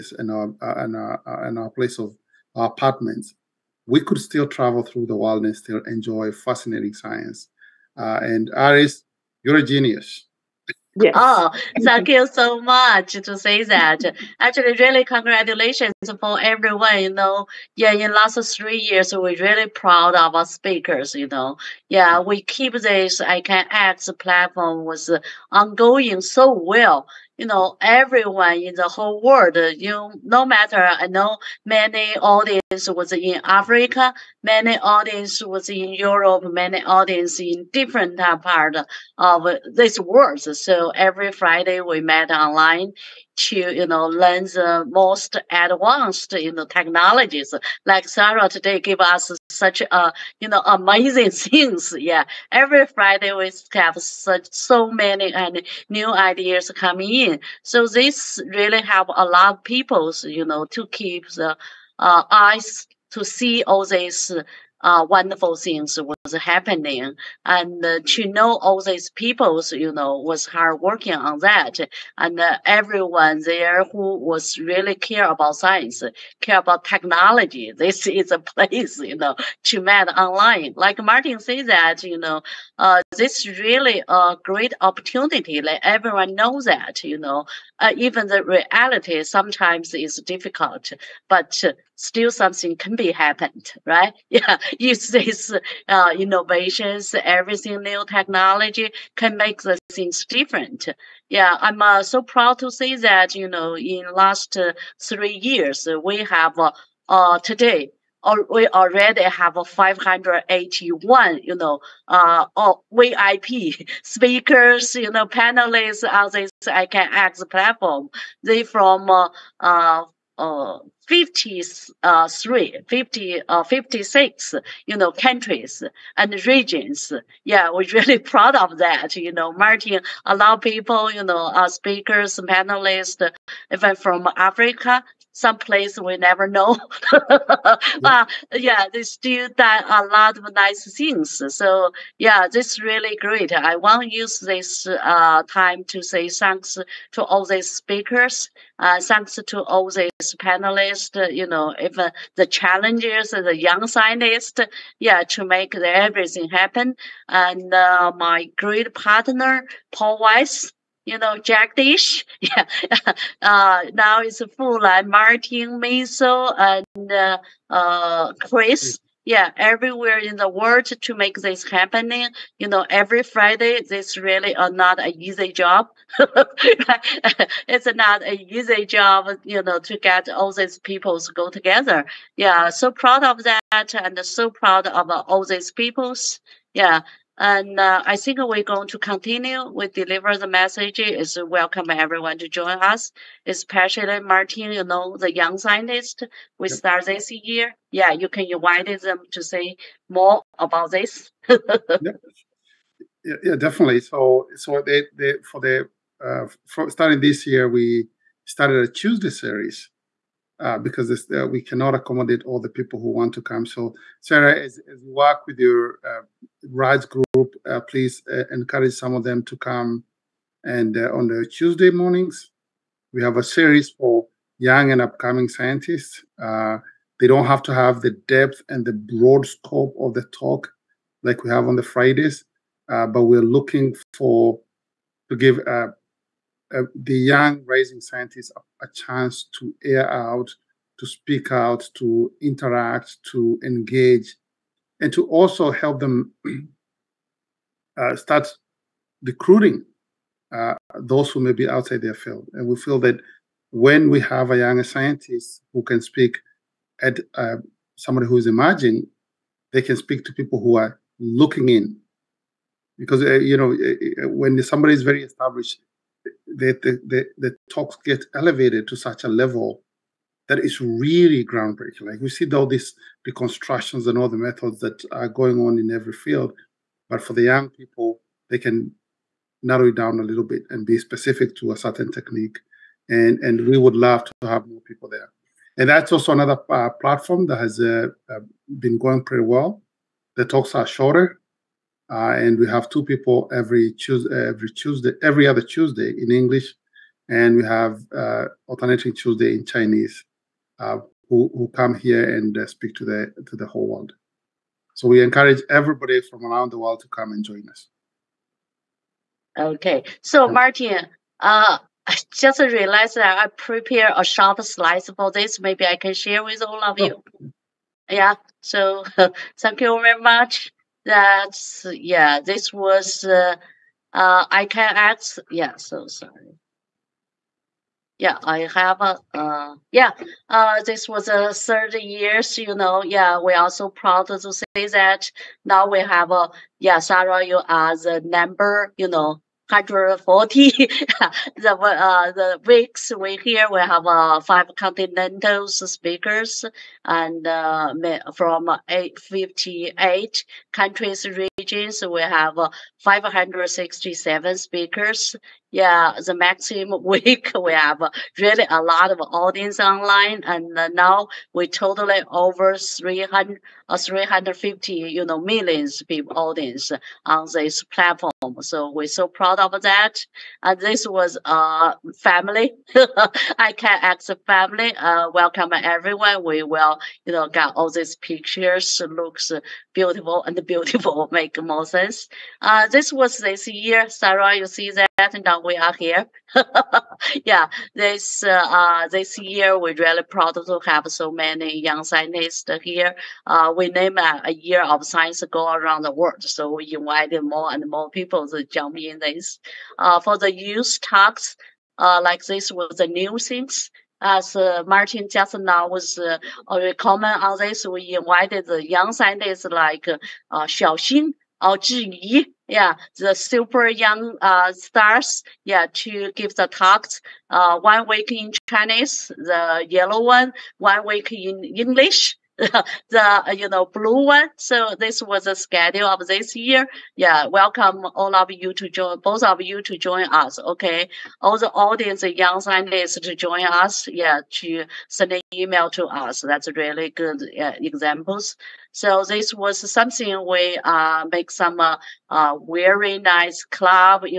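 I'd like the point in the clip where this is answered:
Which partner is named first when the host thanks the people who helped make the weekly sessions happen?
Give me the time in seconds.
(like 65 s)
159 s.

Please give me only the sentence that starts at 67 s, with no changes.
And uh, to know all these people, you know, was hard working on that.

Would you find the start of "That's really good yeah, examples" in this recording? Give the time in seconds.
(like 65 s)
436 s.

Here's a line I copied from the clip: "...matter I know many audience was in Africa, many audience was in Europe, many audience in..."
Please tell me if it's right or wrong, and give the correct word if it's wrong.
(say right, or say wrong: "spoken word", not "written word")
right.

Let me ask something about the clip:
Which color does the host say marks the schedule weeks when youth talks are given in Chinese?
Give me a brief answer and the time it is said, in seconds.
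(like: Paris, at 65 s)
Yellow, at 419 s.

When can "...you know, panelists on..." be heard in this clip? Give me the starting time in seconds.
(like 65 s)
114 s.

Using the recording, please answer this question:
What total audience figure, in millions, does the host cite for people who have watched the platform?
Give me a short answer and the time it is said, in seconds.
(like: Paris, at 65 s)
350 million, at 363 s.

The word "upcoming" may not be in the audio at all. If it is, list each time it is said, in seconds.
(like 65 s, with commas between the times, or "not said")
225 s.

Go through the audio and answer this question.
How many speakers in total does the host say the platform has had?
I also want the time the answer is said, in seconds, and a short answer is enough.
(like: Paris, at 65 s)
567, at 353 s.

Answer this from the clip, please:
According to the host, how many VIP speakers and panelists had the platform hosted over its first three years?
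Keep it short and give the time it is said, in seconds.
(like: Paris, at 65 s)
581, at 109 s.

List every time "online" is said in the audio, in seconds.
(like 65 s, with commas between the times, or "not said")
42 s, 80 s, 359 s.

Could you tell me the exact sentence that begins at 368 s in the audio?
So we're so proud of that.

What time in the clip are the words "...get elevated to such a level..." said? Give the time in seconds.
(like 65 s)
268 s.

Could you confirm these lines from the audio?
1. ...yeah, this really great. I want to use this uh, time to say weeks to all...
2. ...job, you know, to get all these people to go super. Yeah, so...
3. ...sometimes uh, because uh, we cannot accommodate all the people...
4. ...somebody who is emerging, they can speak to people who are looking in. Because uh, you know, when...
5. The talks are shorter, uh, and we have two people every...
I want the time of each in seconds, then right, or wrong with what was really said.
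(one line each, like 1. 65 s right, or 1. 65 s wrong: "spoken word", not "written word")
1. 142 s wrong: "thanks", not "weeks"
2. 178 s wrong: "together", not "super"
3. 209 s wrong: "series", not "sometimes"
4. 257 s right
5. 290 s right.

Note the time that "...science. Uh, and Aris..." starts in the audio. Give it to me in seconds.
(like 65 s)
6 s.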